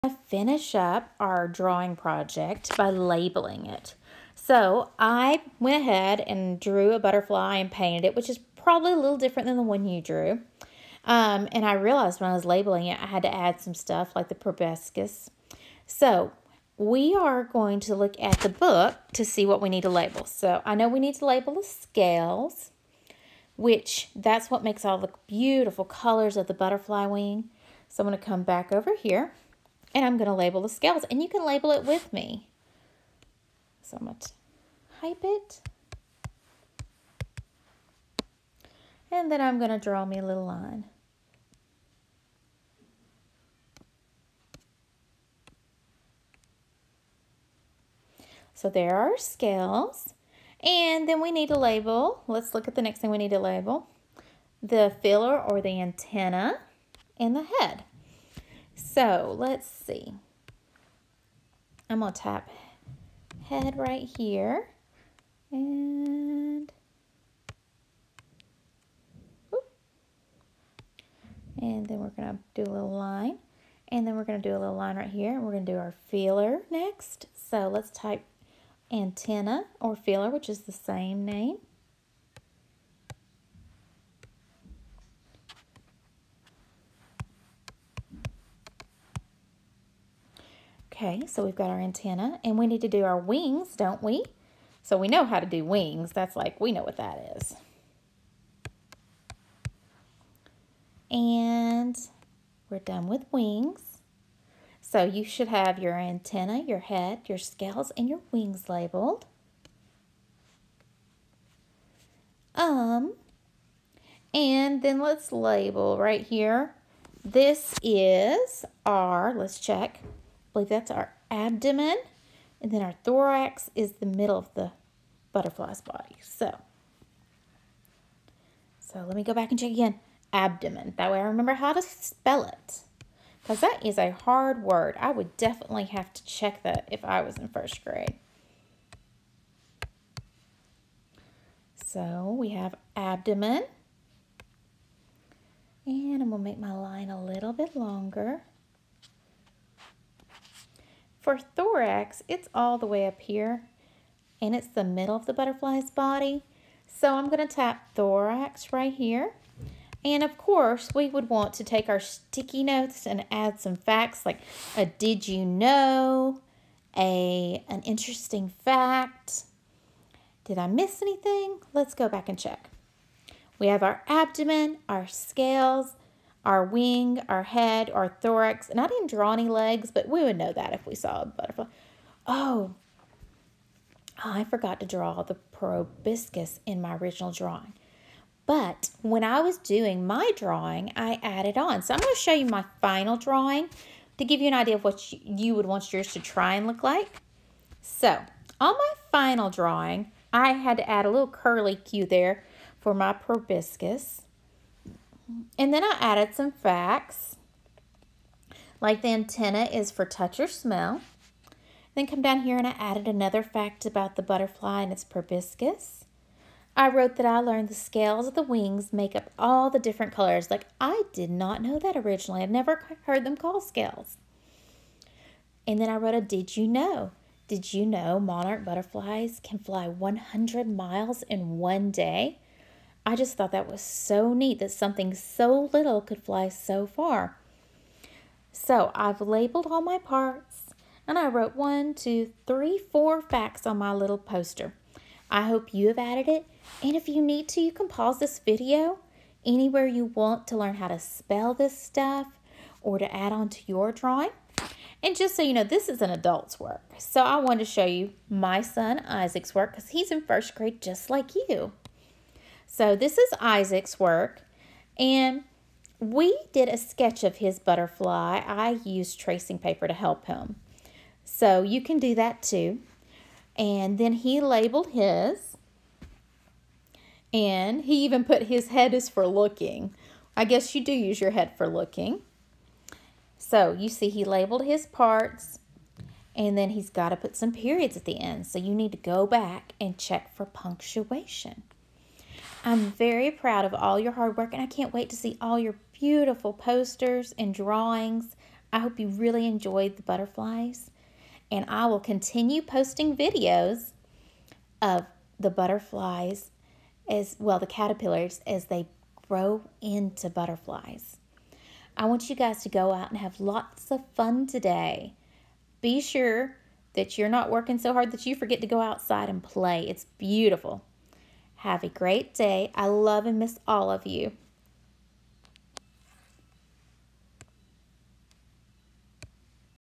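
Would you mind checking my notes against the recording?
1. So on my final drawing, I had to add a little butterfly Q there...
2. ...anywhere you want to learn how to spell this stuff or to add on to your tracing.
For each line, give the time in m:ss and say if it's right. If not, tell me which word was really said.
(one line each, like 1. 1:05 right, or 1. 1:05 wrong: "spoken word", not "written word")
1. 3:17 wrong: "curly", not "butterfly"
2. 4:09 wrong: "drawing", not "tracing".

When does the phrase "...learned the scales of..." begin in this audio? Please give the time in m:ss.
3:37.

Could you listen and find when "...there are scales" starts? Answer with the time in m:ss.
0:48.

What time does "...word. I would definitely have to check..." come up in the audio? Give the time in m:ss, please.
2:14.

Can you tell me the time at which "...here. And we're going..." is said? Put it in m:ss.
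1:15.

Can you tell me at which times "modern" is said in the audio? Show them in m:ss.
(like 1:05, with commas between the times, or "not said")
not said.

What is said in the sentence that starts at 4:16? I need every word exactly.
So I wanted to show you my son Isaac's work because he's in first grade just like you.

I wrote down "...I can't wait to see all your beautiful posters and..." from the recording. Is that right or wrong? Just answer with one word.
right.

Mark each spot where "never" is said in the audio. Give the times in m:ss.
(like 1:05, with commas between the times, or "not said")
3:42.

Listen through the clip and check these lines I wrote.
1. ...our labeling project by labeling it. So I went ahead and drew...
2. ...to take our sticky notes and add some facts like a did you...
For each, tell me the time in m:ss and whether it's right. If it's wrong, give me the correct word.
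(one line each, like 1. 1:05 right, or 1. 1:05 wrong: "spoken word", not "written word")
1. 0:01 wrong: "drawing", not "labeling"
2. 2:41 right.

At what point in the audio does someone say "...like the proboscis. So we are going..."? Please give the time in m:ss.
0:14.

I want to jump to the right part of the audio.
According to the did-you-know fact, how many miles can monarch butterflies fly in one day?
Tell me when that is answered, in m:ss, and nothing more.
3:49.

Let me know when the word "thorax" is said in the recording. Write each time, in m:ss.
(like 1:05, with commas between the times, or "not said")
2:03, 2:31, 2:37, 2:58.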